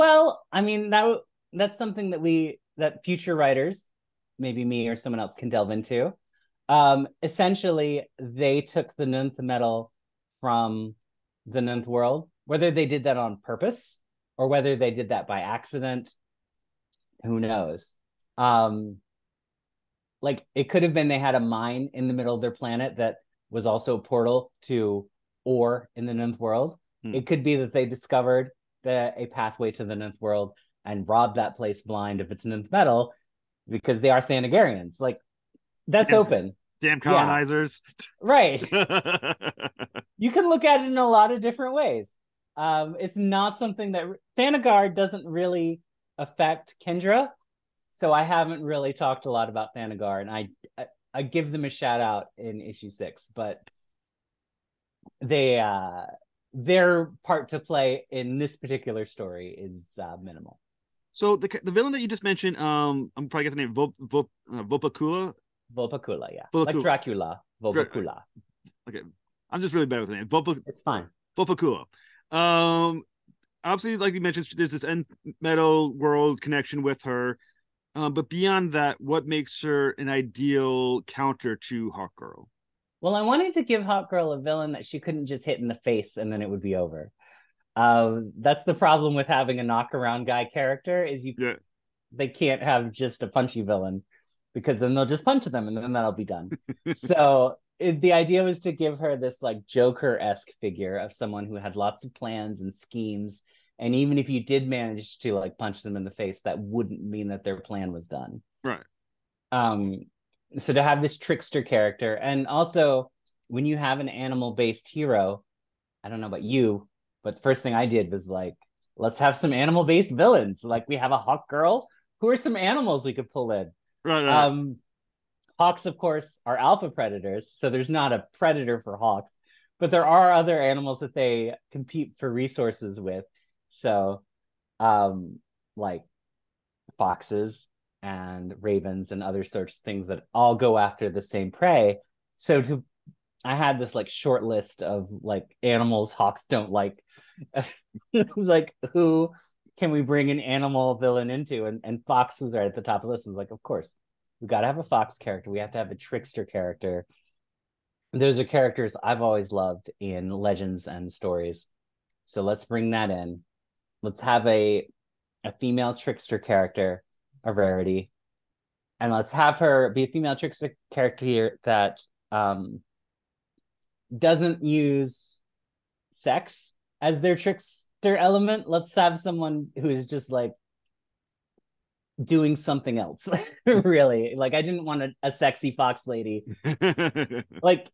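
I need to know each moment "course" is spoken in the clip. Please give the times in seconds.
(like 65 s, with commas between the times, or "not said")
125 s, 153 s.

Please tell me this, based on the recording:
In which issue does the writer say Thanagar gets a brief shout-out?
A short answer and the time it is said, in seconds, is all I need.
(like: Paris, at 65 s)
6, at 52 s.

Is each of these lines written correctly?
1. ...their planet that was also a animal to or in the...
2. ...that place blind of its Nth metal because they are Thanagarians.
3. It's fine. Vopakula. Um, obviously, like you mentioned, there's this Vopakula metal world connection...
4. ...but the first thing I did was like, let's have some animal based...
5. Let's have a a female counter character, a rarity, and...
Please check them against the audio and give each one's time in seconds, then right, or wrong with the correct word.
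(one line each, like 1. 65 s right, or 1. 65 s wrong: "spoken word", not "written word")
1. 22 s wrong: "portal", not "animal"
2. 31 s right
3. 70 s wrong: "Nth", not "Vopakula"
4. 117 s right
5. 164 s wrong: "trickster", not "counter".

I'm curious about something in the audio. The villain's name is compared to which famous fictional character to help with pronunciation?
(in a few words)
Dracula.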